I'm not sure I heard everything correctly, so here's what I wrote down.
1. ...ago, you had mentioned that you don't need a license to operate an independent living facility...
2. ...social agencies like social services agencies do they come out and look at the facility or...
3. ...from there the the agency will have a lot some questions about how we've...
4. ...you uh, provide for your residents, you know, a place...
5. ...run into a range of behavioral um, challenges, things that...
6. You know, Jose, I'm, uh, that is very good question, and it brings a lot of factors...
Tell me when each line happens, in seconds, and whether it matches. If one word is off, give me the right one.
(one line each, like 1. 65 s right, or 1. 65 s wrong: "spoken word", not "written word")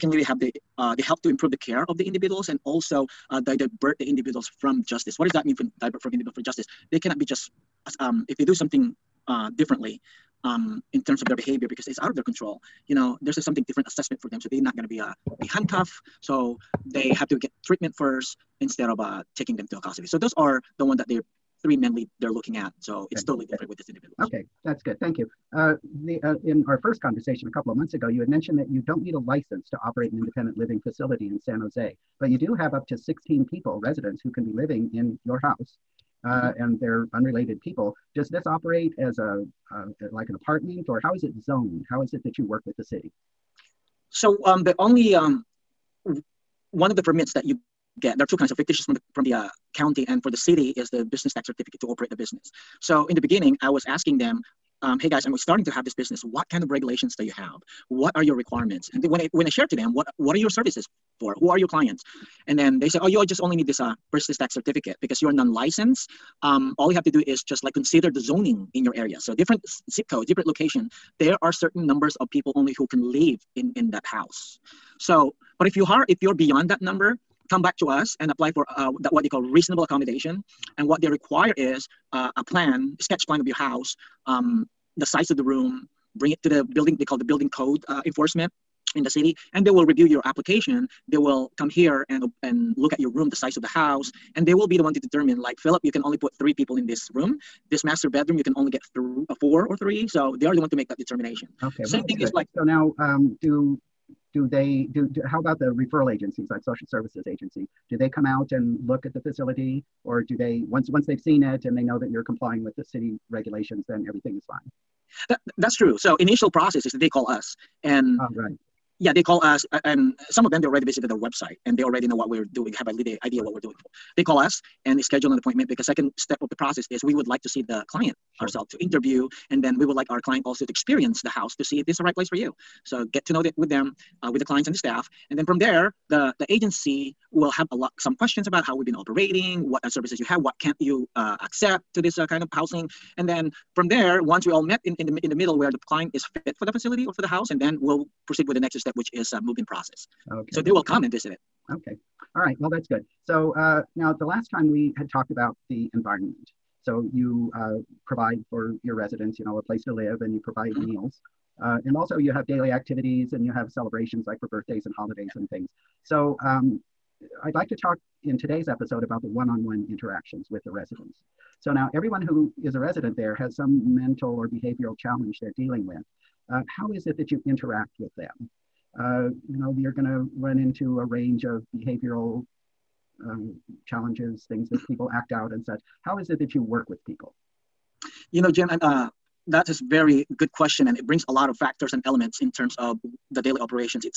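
1. 27 s right
2. 105 s wrong: "referral", not "social"
3. 135 s right
4. 157 s right
5. 180 s right
6. 188 s wrong: "Jim", not "Jose".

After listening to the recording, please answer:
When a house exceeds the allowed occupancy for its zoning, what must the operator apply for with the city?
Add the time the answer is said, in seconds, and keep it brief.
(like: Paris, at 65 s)
Reasonable accommodation, at 79 s.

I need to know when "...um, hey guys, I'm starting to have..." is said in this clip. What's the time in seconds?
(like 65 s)
54 s.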